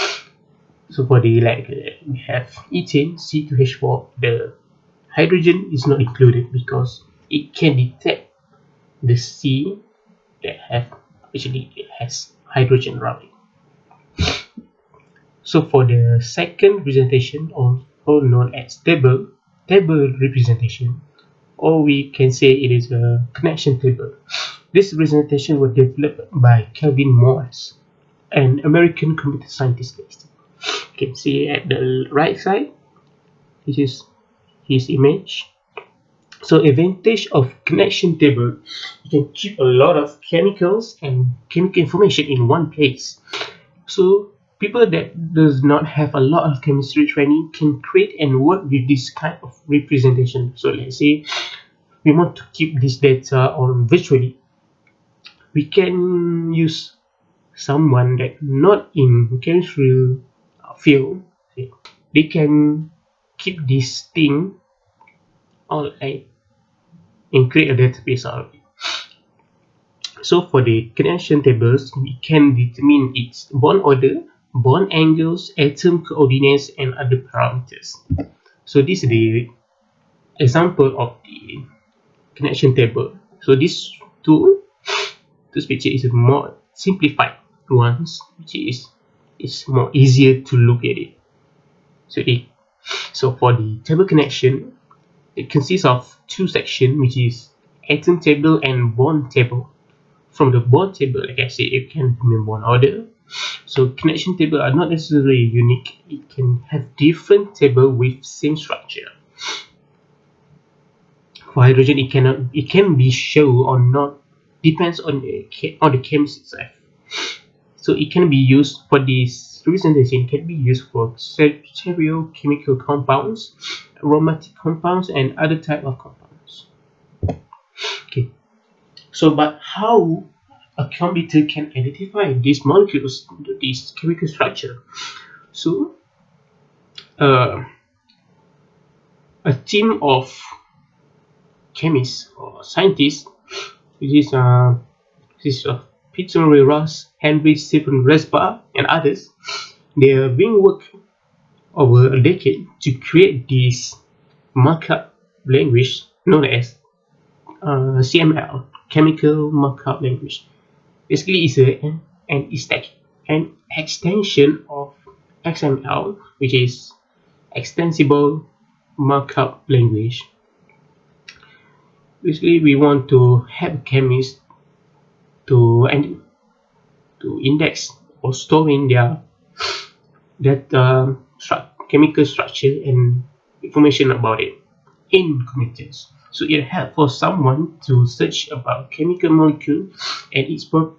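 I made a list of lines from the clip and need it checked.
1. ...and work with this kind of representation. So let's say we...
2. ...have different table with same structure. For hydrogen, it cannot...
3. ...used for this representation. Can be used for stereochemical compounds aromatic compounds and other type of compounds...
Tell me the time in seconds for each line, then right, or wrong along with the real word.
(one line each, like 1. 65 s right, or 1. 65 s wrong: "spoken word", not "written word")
1. 48 s right
2. 106 s right
3. 118 s right.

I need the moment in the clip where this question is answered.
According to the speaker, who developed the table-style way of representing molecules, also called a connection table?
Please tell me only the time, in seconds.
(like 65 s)
26 s.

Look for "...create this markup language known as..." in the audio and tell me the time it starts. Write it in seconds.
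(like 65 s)
152 s.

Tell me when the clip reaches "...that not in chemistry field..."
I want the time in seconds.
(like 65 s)
58 s.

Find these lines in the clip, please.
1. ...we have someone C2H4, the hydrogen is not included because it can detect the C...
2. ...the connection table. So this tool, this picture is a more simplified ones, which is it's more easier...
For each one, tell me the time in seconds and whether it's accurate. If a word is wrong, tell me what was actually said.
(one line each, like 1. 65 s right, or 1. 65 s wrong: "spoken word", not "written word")
1. 2 s wrong: "ethane", not "someone"
2. 81 s right.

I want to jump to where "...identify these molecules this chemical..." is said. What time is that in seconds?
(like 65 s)
131 s.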